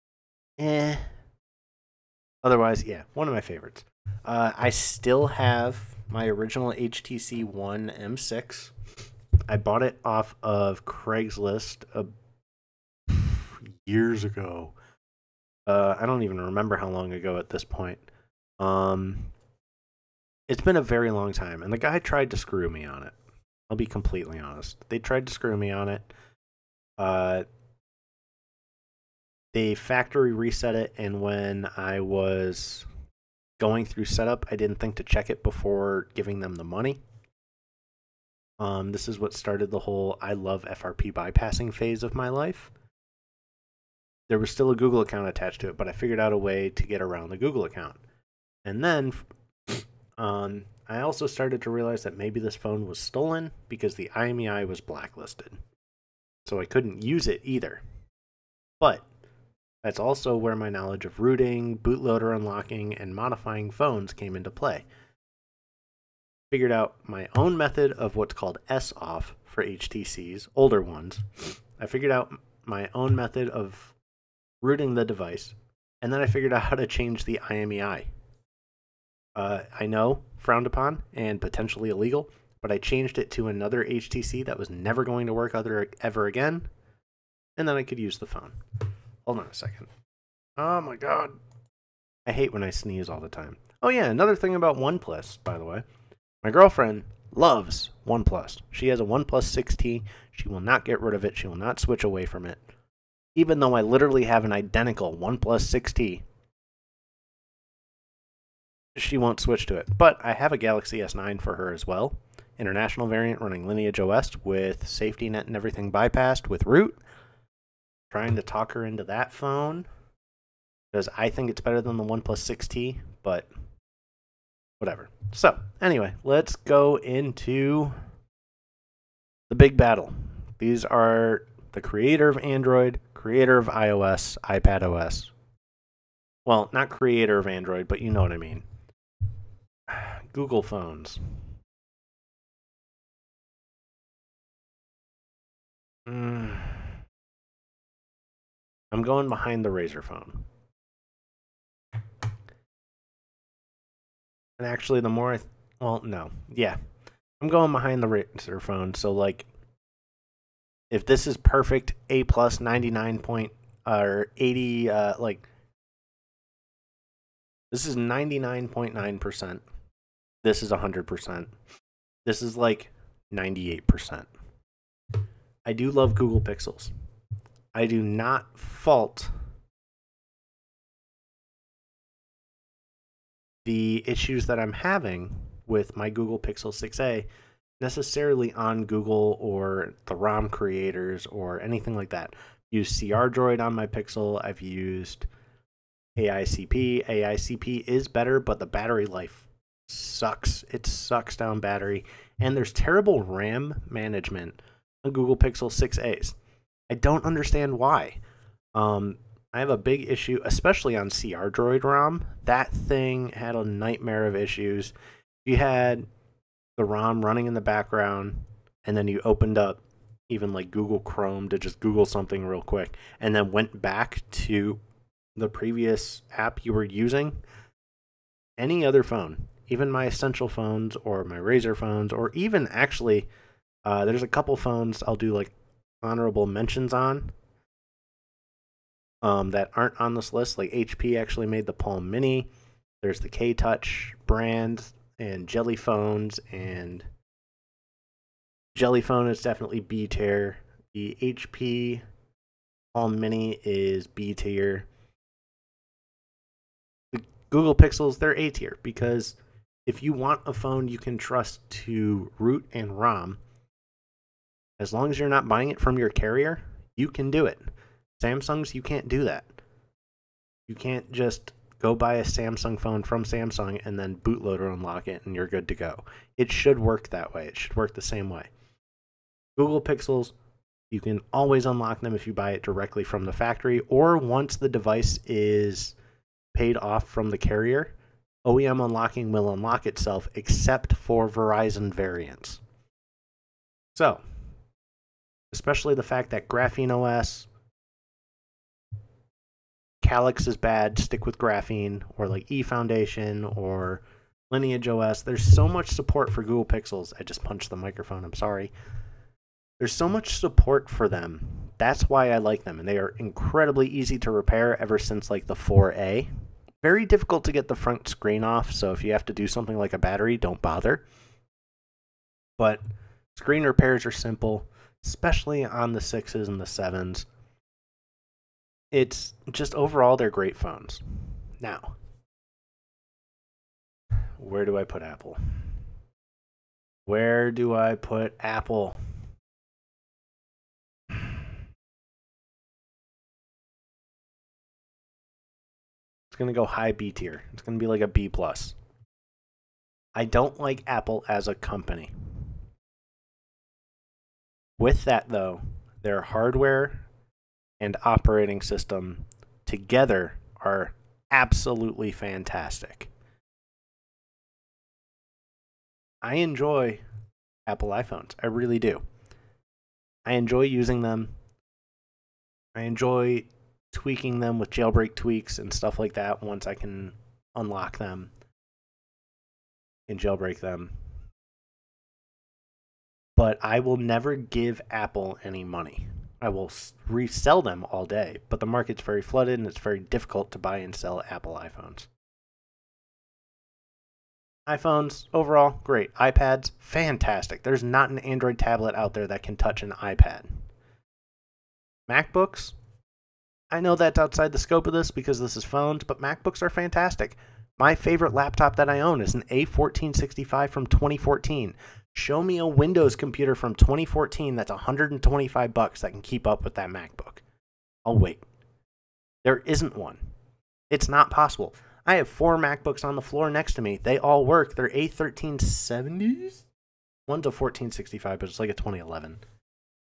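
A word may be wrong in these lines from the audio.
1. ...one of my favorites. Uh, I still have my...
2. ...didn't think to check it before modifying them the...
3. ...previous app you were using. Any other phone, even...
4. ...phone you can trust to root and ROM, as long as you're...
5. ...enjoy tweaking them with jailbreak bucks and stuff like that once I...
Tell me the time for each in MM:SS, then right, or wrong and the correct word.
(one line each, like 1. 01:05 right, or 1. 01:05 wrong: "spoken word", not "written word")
1. 00:03 right
2. 00:34 wrong: "giving", not "modifying"
3. 03:45 right
4. 04:20 right
5. 06:12 wrong: "tweaks", not "bucks".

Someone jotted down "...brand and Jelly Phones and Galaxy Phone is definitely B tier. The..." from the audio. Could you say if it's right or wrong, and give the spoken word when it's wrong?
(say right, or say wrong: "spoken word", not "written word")
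wrong: "Jelly", not "Galaxy".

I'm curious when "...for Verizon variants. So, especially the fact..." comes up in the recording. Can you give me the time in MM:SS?
04:50.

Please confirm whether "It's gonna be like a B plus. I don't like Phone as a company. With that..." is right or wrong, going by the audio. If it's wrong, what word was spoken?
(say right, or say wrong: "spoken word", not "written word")
wrong: "Apple", not "Phone".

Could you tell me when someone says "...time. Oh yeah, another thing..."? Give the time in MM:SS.
01:33.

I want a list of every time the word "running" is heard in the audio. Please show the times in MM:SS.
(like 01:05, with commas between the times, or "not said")
01:53, 03:37.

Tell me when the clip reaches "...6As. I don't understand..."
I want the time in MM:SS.
03:25.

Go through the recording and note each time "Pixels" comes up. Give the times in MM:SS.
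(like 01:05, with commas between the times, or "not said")
02:56, 03:06, 03:13, 03:25, 04:17, 04:39, 05:06.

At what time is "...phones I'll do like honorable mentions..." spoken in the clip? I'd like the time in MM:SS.
03:54.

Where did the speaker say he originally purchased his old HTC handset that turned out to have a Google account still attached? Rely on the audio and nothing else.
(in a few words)
Craigslist.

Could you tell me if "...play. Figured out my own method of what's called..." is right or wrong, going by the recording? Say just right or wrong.
right.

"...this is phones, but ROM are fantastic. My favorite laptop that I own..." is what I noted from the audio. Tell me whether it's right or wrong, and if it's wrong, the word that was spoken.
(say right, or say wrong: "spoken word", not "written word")
wrong: "MacBooks", not "ROM".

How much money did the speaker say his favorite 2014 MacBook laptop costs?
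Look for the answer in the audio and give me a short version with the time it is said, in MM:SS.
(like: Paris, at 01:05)
$125, at 06:54.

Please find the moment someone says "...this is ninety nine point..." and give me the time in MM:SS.
02:47.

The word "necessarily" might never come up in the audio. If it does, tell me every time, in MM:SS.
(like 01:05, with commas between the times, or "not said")
03:07.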